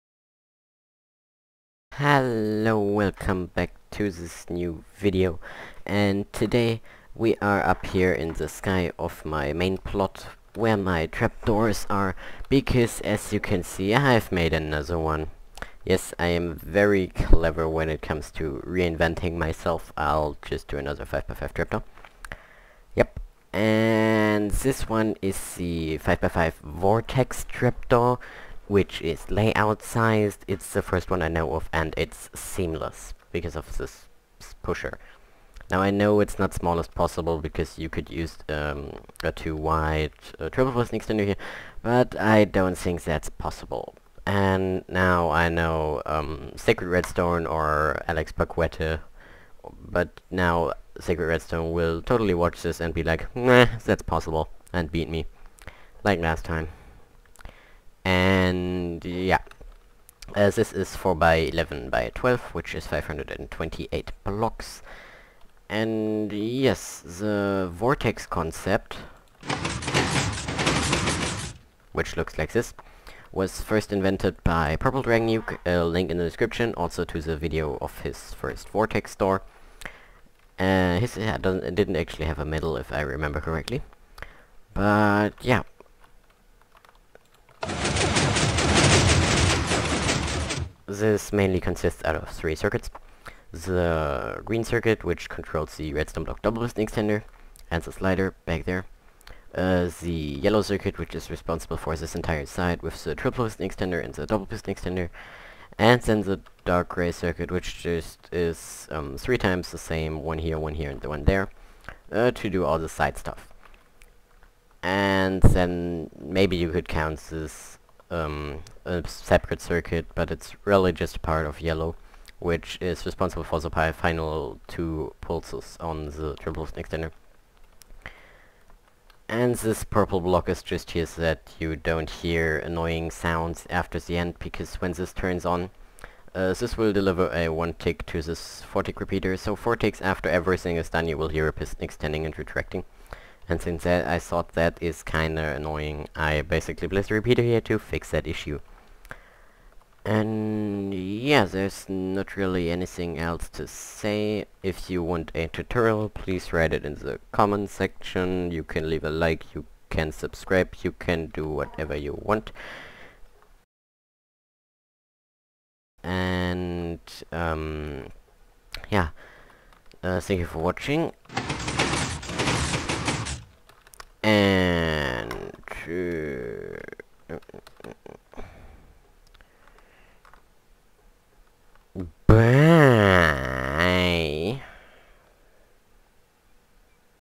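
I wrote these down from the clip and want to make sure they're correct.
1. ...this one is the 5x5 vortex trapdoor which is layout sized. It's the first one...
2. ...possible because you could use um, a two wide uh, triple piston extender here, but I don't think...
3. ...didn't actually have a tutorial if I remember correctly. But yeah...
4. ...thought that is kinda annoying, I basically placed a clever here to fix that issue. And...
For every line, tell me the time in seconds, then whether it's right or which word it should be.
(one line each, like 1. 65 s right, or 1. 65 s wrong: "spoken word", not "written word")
1. 24 s right
2. 36 s right
3. 81 s wrong: "medal", not "tutorial"
4. 144 s wrong: "repeater", not "clever".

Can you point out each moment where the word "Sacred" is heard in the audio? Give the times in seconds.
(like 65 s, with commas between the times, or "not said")
46 s, 50 s.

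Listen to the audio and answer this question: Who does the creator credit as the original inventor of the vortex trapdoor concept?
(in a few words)
Purple Dragon Nuke.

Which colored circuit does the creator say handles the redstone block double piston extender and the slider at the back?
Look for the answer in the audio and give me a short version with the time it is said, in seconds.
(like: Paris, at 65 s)
Green, at 93 s.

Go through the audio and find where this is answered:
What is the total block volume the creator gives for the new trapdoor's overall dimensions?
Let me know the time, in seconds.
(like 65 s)
62 s.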